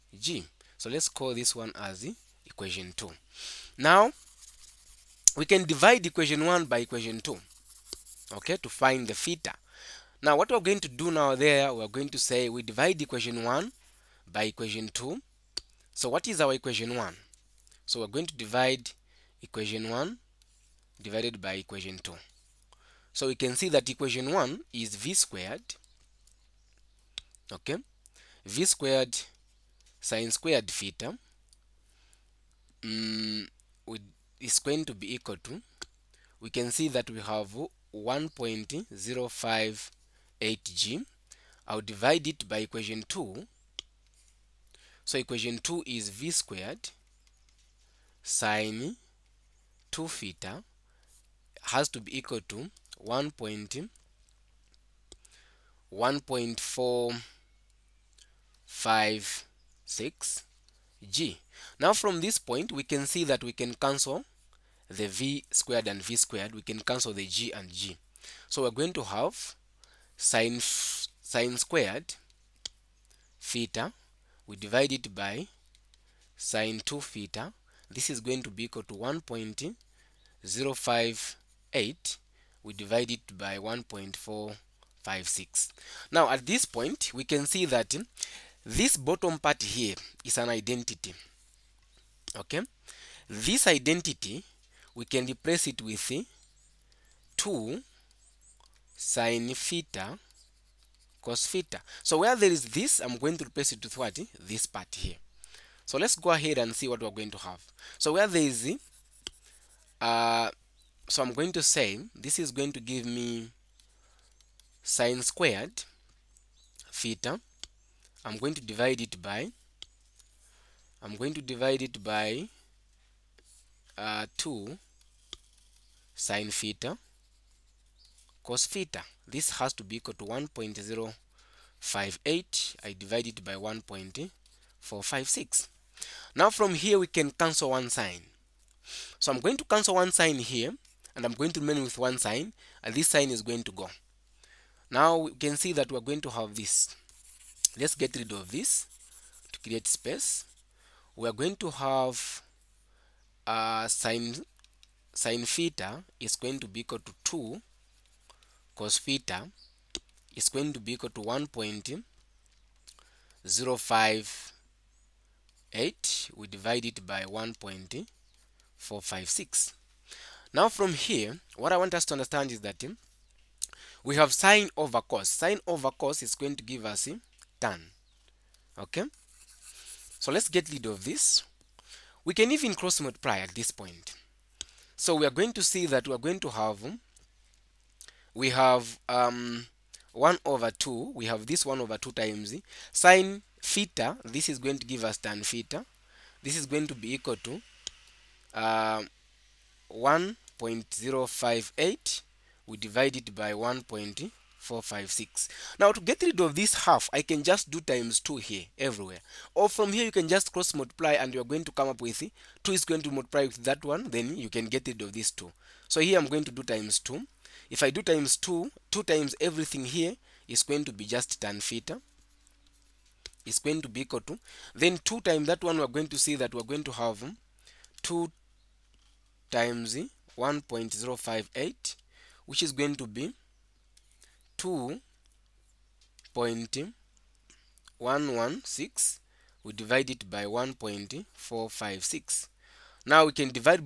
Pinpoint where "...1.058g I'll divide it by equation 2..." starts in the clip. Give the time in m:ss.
0:37.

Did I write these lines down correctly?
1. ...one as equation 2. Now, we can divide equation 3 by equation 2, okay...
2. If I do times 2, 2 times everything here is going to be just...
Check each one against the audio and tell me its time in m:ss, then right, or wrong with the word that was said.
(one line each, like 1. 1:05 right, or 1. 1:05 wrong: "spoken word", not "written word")
1. 0:01 wrong: "1", not "3"
2. 3:37 right.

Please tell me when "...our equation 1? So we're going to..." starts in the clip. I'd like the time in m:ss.
0:16.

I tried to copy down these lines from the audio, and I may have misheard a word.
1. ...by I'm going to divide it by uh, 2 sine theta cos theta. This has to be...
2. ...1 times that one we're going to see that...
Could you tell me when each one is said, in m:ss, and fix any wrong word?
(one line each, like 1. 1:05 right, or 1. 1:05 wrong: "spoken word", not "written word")
1. 1:59 right
2. 3:45 wrong: "2", not "1".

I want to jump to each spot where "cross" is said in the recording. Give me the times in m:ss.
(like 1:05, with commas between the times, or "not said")
3:02, 3:30.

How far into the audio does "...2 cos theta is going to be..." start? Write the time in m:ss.
2:37.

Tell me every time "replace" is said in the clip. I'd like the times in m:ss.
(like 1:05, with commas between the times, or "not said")
1:35, 1:43.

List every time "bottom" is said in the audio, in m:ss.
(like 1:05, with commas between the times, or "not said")
1:28.